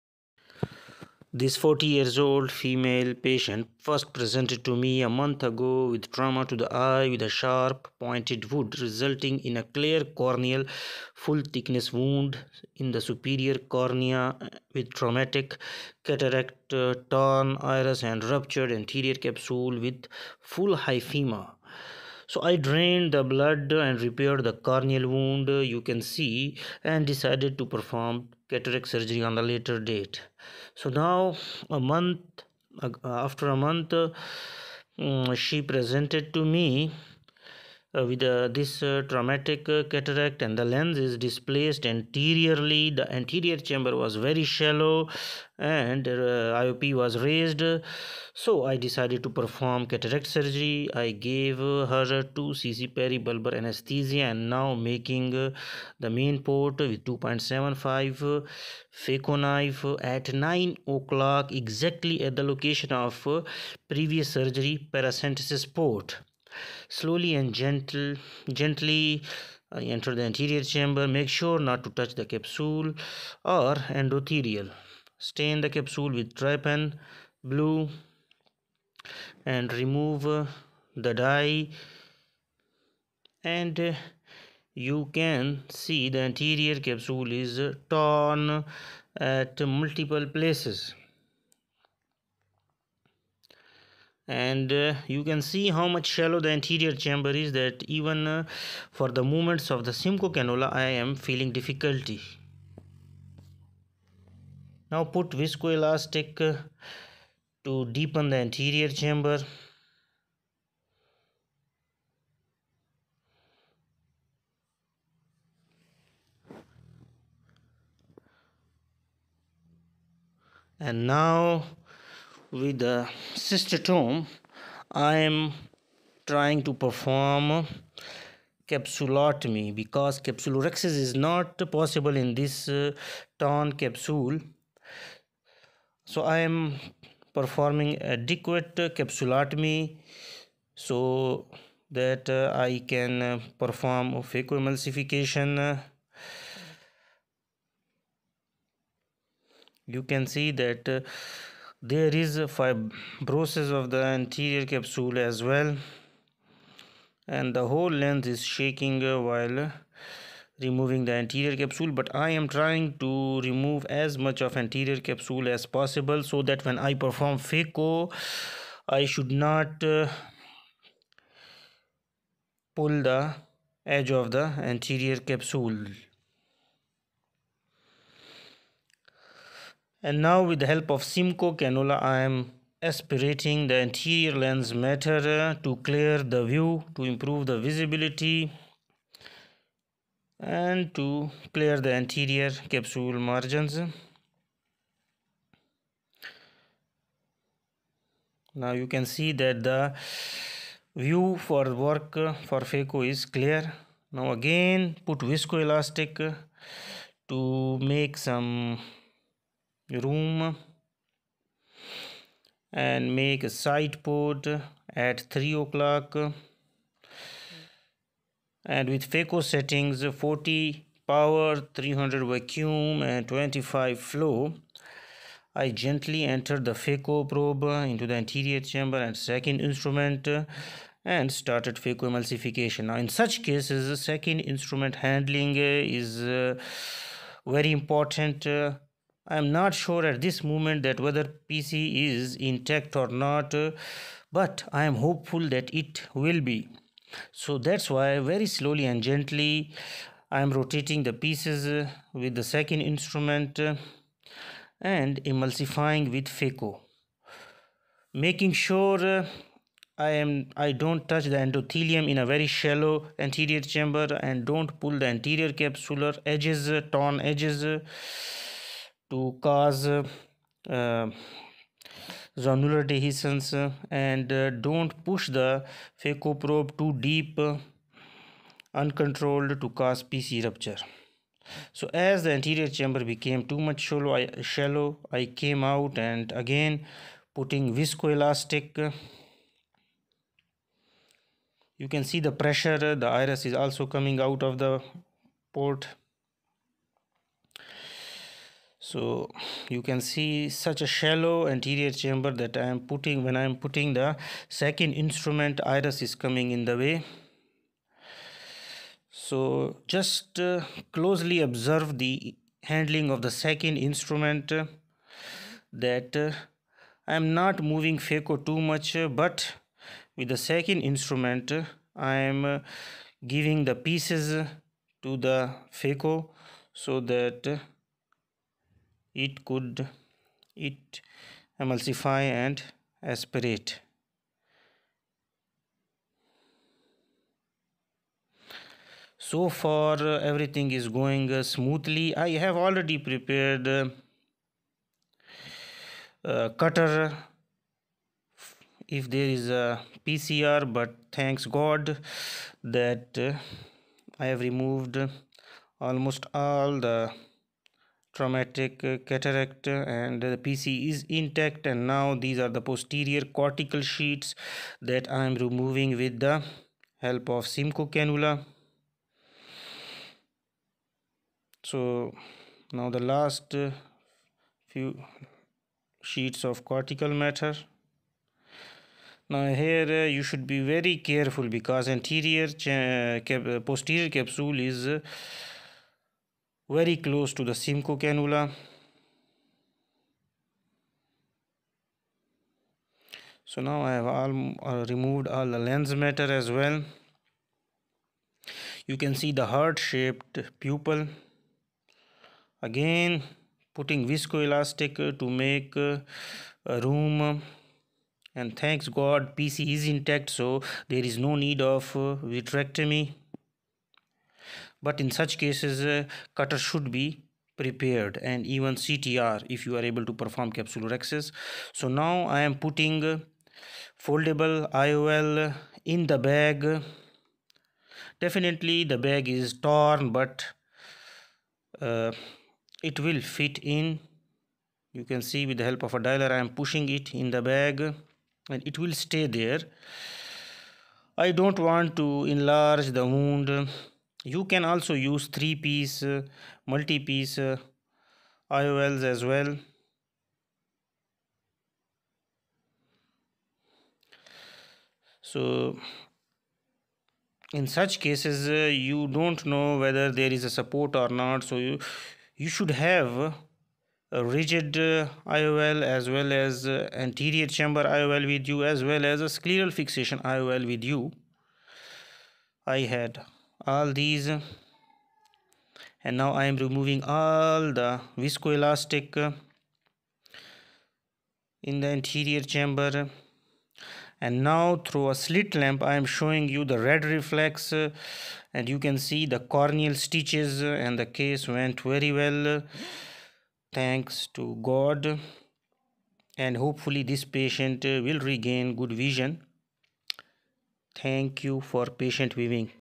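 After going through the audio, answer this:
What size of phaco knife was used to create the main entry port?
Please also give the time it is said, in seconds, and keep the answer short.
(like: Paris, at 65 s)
2.75, at 57 s.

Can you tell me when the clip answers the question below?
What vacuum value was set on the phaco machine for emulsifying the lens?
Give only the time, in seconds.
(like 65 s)
221 s.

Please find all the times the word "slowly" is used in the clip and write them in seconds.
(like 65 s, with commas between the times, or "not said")
66 s, 248 s.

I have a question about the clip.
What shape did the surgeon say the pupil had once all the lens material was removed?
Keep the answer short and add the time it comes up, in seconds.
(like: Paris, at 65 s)
heart shaped, at 399 s.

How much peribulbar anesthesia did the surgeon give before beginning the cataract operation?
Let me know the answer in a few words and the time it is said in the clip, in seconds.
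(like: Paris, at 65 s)
2 cc, at 52 s.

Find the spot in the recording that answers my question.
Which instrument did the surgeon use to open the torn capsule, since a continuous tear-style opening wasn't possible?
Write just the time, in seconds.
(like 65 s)
123 s.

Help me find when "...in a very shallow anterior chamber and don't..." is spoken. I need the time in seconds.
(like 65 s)
262 s.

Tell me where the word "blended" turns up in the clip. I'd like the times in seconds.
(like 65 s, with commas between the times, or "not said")
not said.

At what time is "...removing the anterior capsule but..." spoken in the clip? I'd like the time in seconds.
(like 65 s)
160 s.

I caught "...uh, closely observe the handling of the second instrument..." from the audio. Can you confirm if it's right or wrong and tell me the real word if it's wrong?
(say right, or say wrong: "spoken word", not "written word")
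right.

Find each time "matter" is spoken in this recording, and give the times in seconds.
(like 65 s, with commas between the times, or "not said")
184 s, 377 s, 395 s.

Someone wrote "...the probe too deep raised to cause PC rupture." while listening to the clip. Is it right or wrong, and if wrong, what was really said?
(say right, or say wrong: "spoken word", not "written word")
wrong: "uncontrolled", not "raised".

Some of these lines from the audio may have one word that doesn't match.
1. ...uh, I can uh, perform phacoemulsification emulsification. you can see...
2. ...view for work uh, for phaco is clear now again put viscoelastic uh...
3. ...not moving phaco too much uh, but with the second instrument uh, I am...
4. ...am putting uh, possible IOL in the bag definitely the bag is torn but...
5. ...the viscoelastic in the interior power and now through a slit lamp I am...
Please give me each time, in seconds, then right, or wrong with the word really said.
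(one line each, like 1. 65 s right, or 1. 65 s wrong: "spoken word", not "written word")
1. 142 s right
2. 200 s right
3. 317 s right
4. 422 s wrong: "foldable", not "possible"
5. 477 s wrong: "chamber", not "power".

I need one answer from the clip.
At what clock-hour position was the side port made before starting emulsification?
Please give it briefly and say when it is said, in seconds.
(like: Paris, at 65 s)
3 o'clock, at 215 s.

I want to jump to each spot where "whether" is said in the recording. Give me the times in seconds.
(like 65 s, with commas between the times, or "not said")
240 s, 459 s.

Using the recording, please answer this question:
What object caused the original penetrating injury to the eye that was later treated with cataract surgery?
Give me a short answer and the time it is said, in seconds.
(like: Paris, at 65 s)
sharp pointed wood, at 7 s.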